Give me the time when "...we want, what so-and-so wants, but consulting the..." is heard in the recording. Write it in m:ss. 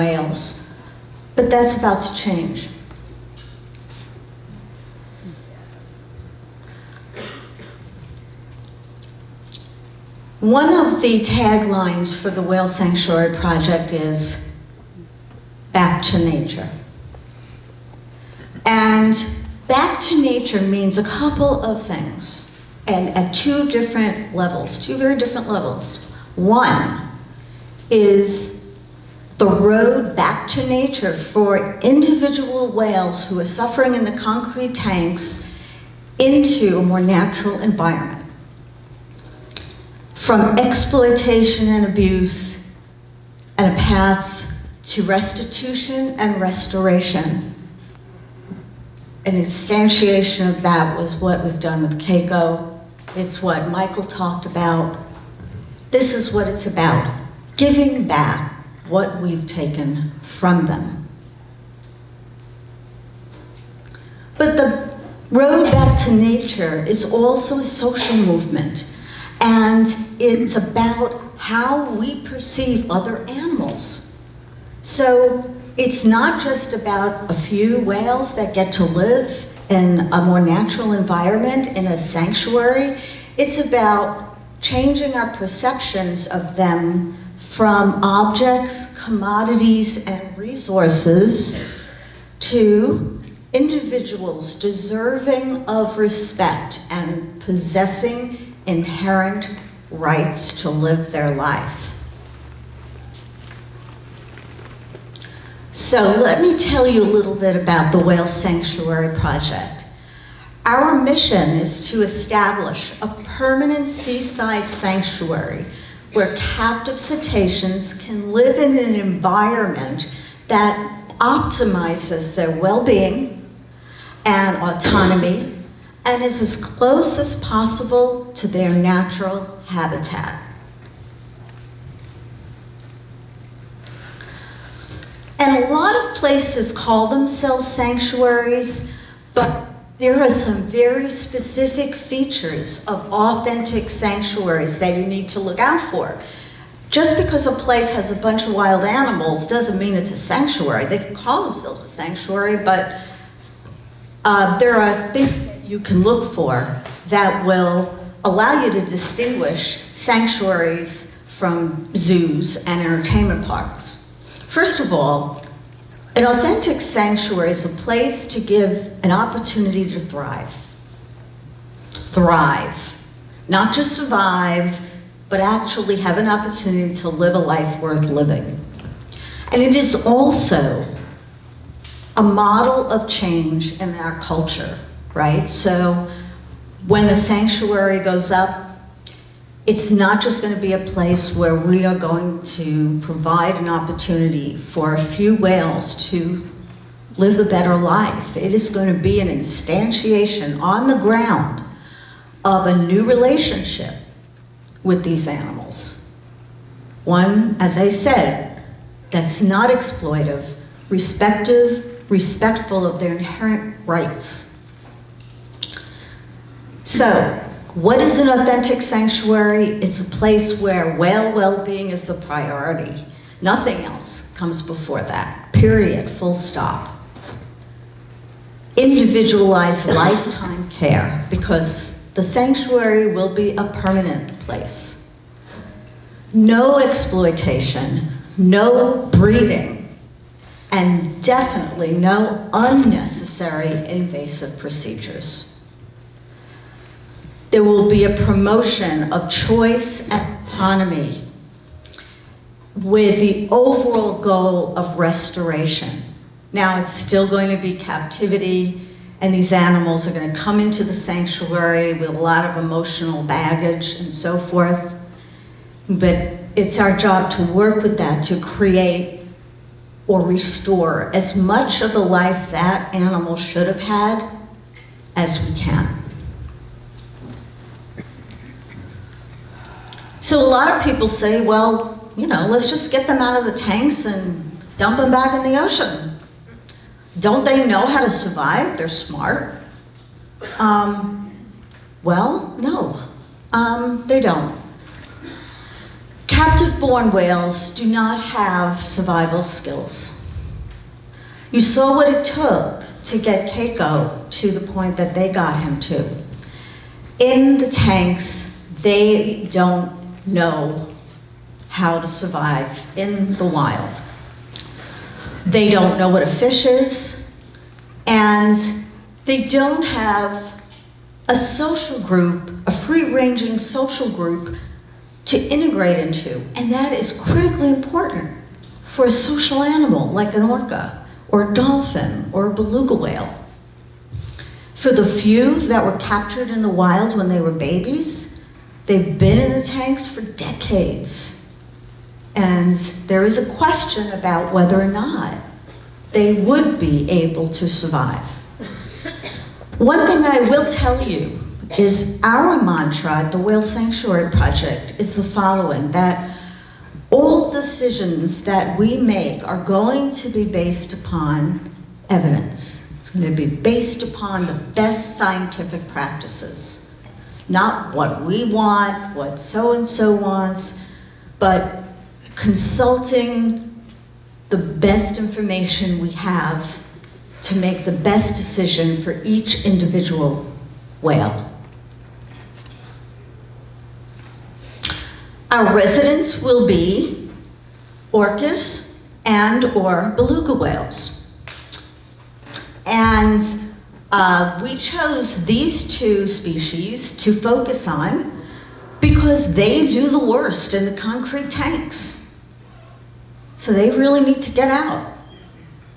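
6:08.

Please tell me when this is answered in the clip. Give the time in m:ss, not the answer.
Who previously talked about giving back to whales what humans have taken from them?
0:53.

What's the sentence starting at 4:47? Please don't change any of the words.
Don't they know how to survive?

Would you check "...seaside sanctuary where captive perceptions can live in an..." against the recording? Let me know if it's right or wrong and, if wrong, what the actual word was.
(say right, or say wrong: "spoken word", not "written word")
wrong: "cetaceans", not "perceptions".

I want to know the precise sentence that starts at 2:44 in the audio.
First of all, an authentic sanctuary is a place to give an opportunity to thrive.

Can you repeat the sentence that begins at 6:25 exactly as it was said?
Our residents will be orcas and or beluga whales.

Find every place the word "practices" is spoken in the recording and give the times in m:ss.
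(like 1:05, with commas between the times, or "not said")
6:05.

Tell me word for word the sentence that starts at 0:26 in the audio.
One is the road back to nature for individual whales who are suffering in the concrete tanks into a more natural environment.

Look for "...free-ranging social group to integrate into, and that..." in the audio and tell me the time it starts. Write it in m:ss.
5:22.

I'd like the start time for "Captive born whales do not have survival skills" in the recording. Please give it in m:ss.
4:56.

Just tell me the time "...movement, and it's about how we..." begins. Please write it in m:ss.
1:08.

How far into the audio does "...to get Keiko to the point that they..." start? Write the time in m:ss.
5:03.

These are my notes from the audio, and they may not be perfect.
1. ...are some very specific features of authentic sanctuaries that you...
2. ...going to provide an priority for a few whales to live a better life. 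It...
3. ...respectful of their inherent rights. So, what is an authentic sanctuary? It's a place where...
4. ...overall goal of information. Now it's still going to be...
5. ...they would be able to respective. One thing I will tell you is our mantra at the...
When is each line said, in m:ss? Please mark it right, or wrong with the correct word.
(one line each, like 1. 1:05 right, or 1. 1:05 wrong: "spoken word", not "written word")
1. 2:20 right
2. 3:11 wrong: "opportunity", not "priority"
3. 3:32 right
4. 4:13 wrong: "restoration", not "information"
5. 5:46 wrong: "survive", not "respective".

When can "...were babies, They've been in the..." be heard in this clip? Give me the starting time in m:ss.
5:37.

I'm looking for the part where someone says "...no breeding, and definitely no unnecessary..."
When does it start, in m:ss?
3:58.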